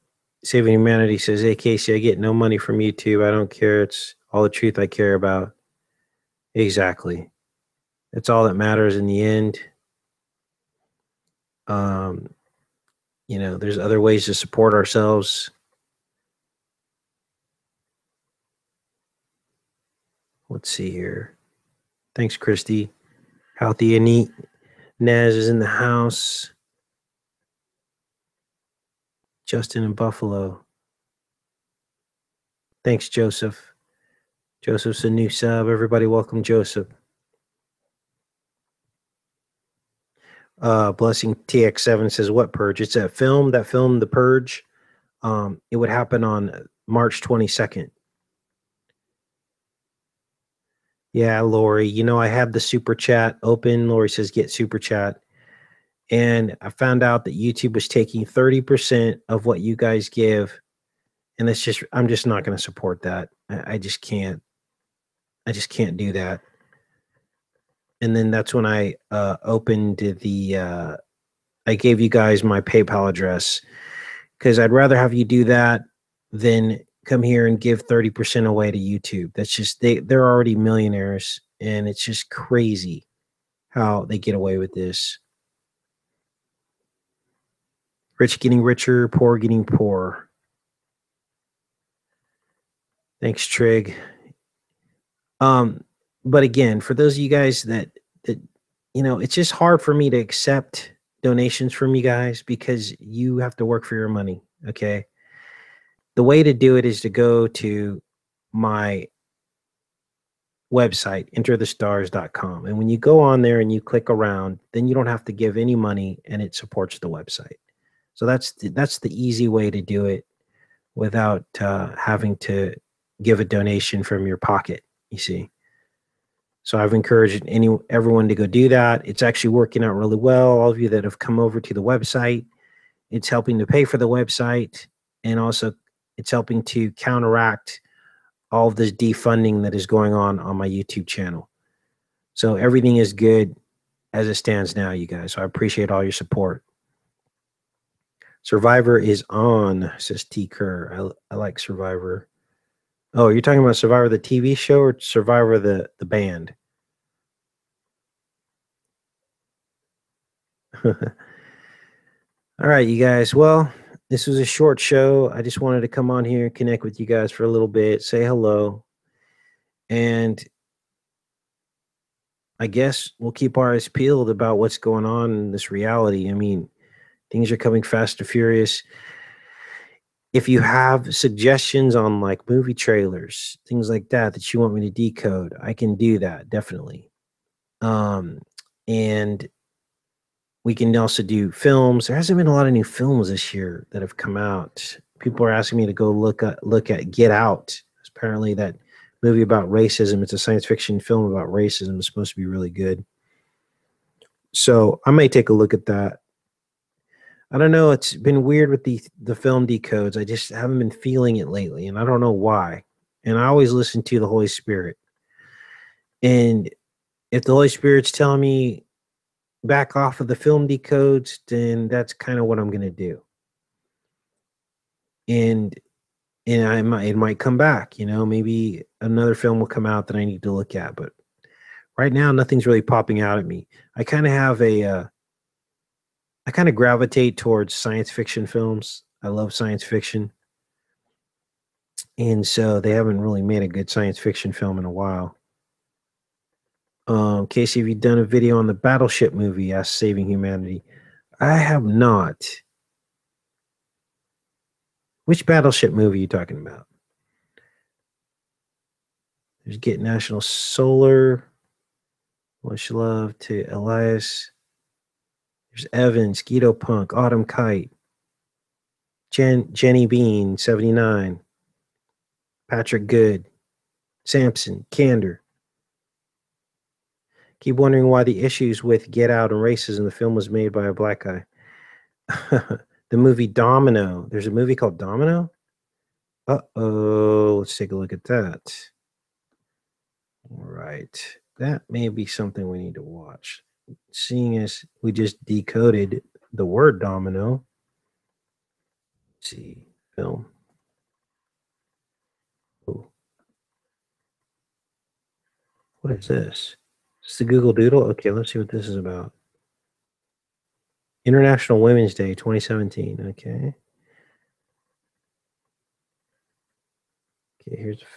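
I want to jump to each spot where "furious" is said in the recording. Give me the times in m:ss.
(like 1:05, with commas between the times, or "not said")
2:58.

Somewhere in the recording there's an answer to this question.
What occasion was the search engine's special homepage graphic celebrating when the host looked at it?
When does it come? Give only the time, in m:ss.
5:11.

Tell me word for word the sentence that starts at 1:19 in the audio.
That's just, they, they're already millionaires and it's just crazy how they get away with this rich getting richer, poor getting poor.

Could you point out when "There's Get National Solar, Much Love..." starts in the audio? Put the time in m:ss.
4:19.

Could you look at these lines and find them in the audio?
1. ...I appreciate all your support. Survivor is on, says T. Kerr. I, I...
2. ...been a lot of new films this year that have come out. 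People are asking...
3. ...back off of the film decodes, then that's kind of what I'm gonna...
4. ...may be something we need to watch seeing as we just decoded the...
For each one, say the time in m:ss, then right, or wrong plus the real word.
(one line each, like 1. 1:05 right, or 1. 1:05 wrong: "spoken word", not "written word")
1. 2:25 right
2. 3:12 right
3. 3:39 right
4. 4:51 right.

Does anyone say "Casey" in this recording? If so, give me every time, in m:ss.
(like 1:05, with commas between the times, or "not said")
0:01, 4:07.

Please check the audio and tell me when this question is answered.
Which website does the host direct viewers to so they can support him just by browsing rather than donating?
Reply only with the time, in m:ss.
1:51.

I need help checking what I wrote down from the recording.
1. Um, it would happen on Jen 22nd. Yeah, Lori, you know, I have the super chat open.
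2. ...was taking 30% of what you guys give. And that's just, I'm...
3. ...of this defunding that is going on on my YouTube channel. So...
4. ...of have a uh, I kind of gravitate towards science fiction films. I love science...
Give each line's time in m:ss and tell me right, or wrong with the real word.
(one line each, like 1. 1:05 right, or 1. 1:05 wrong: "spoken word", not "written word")
1. 0:45 wrong: "March", not "Jen"
2. 0:57 right
3. 2:18 right
4. 3:54 right.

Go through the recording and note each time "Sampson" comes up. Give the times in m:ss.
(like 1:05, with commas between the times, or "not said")
4:34.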